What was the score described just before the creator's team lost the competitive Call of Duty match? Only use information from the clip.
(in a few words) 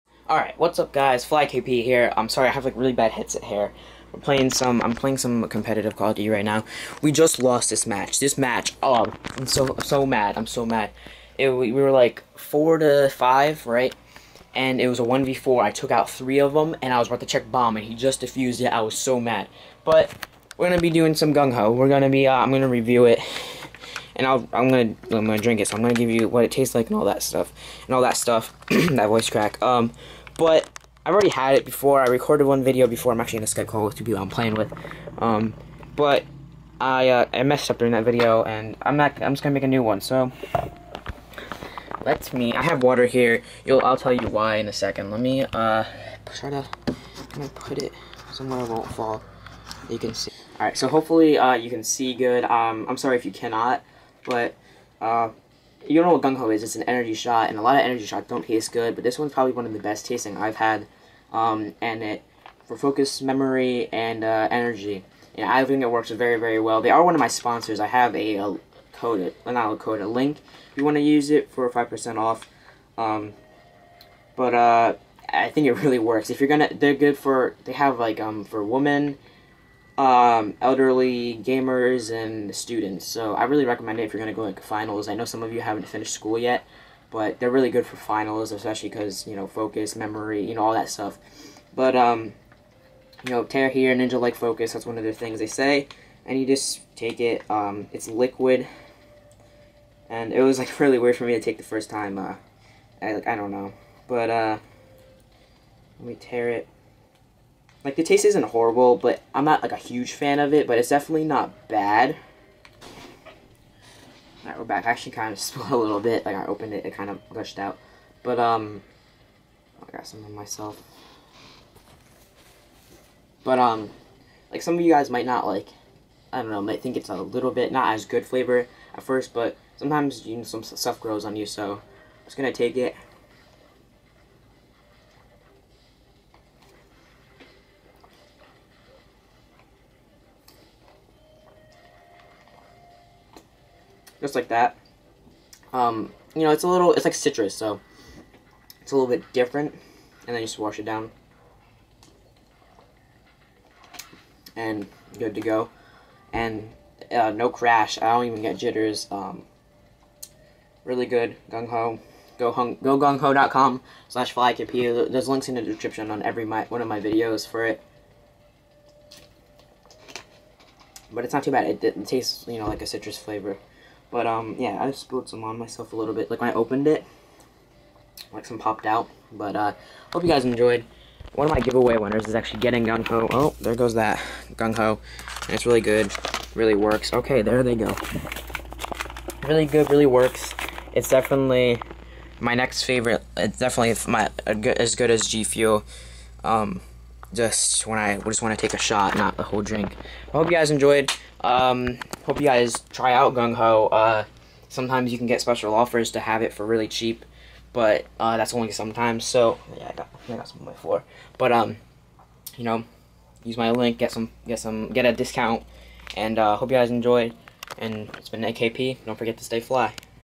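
4 to 5.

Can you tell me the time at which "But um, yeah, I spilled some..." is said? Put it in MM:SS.
02:54.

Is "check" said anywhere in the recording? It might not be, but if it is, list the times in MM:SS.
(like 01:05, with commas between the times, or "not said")
00:17.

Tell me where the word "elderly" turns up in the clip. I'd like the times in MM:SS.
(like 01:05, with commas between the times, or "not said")
01:20.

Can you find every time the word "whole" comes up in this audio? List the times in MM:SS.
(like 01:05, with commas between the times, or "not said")
03:19.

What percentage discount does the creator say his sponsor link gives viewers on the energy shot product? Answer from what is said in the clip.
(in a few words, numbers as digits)
5%.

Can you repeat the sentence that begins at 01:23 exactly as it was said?
So I really recommend it if you're going to go like finals.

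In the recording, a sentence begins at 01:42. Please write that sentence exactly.
Uh, I like I don't know, but uh, let me tear it.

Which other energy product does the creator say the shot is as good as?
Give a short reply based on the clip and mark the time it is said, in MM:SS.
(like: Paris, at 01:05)
G Fuel, at 03:15.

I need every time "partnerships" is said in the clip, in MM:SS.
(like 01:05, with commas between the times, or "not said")
not said.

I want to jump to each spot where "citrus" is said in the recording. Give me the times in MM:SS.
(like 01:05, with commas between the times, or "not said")
02:27, 02:52.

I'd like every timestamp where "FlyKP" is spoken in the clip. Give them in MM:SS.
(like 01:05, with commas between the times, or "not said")
00:01.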